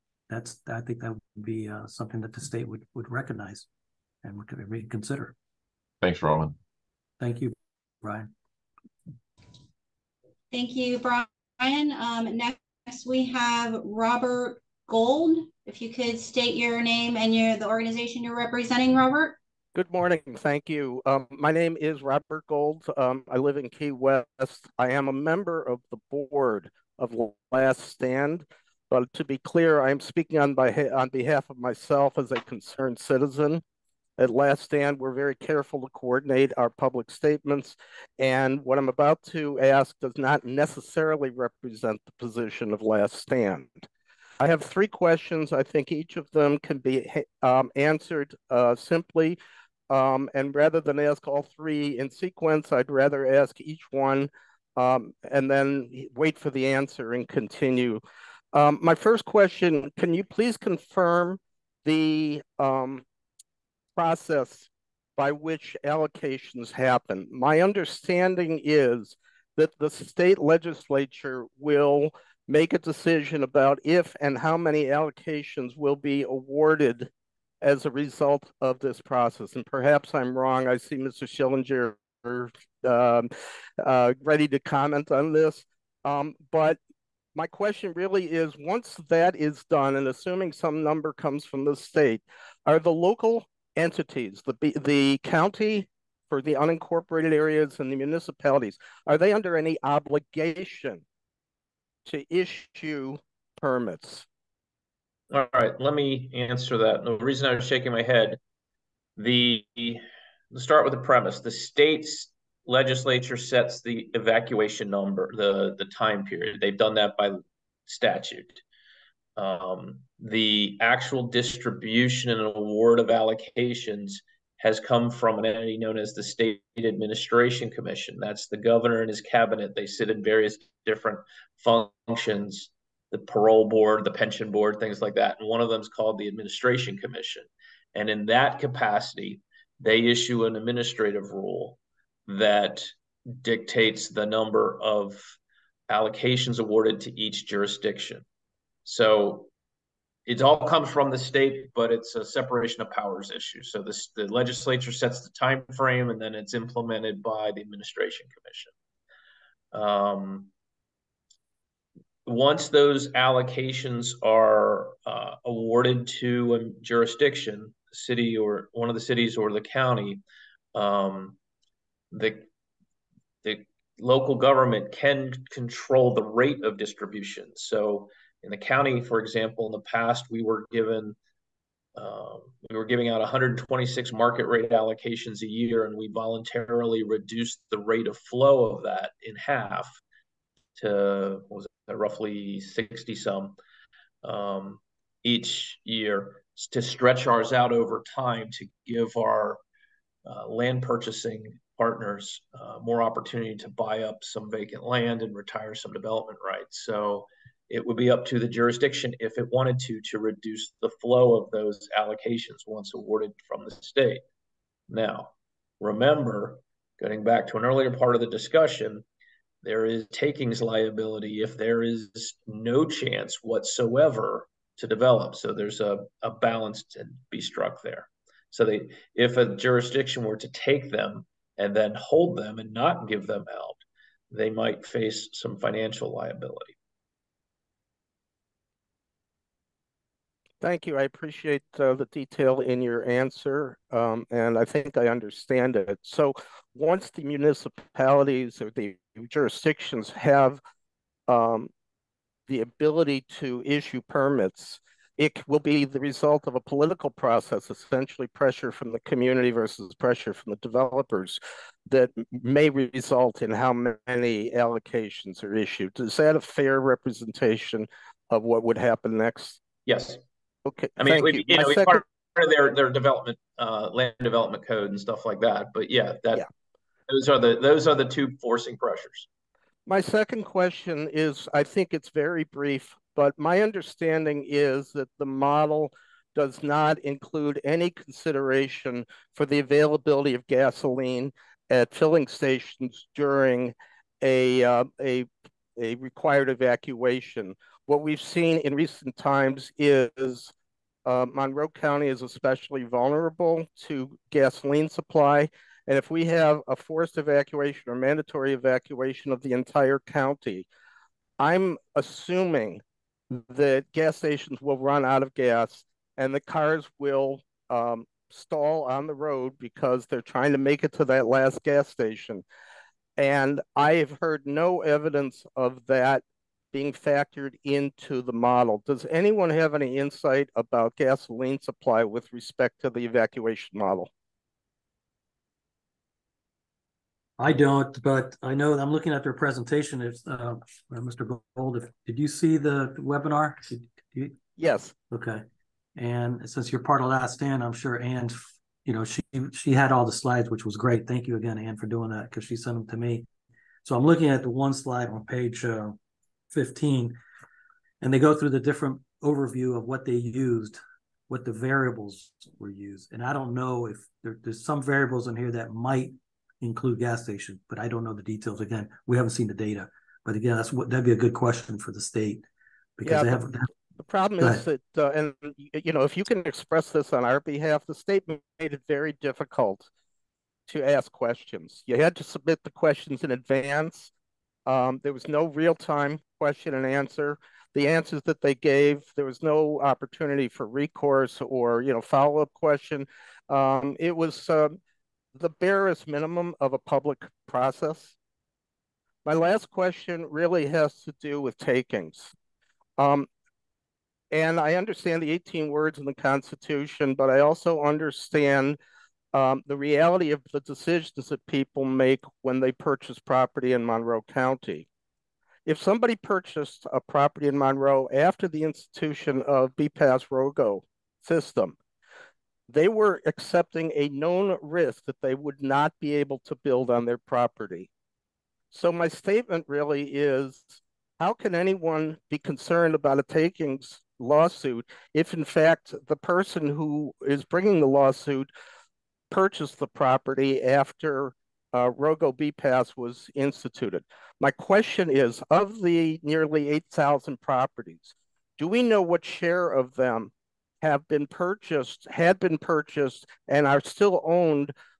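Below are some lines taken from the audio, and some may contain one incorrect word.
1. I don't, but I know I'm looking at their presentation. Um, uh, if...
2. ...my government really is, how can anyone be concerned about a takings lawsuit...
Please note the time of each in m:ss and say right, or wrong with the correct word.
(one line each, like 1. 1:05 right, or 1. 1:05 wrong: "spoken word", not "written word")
1. 5:37 right
2. 7:08 wrong: "statement", not "government".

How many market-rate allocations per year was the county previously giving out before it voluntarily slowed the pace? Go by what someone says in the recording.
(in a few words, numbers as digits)
126.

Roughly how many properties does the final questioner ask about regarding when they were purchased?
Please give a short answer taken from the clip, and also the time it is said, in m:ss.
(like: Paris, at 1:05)
8,000, at 7:26.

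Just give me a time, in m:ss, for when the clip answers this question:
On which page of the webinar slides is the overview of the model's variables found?
5:56.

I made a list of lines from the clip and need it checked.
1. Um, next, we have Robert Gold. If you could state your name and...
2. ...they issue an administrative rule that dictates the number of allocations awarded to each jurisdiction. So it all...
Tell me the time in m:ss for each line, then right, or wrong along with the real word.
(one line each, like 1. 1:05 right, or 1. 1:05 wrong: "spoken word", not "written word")
1. 0:11 right
2. 2:19 right.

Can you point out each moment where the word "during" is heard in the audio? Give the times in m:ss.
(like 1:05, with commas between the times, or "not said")
4:53.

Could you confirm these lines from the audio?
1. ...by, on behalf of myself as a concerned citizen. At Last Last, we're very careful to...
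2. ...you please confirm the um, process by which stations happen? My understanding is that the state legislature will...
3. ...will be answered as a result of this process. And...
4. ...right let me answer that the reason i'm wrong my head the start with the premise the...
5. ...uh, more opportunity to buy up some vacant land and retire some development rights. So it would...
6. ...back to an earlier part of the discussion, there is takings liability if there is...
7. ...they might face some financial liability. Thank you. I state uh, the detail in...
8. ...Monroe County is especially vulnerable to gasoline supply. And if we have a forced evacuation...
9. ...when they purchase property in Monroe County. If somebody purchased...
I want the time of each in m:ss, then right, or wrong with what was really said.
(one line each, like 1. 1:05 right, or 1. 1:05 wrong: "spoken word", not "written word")
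1. 0:30 wrong: "Stand", not "Last"
2. 1:00 wrong: "allocations", not "stations"
3. 1:15 wrong: "awarded", not "answered"
4. 1:45 wrong: "shaking", not "wrong"
5. 3:22 right
6. 3:37 right
7. 3:54 wrong: "appreciate", not "state"
8. 5:01 right
9. 6:52 right.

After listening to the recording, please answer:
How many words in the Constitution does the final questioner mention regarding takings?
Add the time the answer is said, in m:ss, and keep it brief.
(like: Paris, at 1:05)
18, at 6:45.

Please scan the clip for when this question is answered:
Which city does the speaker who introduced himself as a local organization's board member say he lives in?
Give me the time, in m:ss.
0:23.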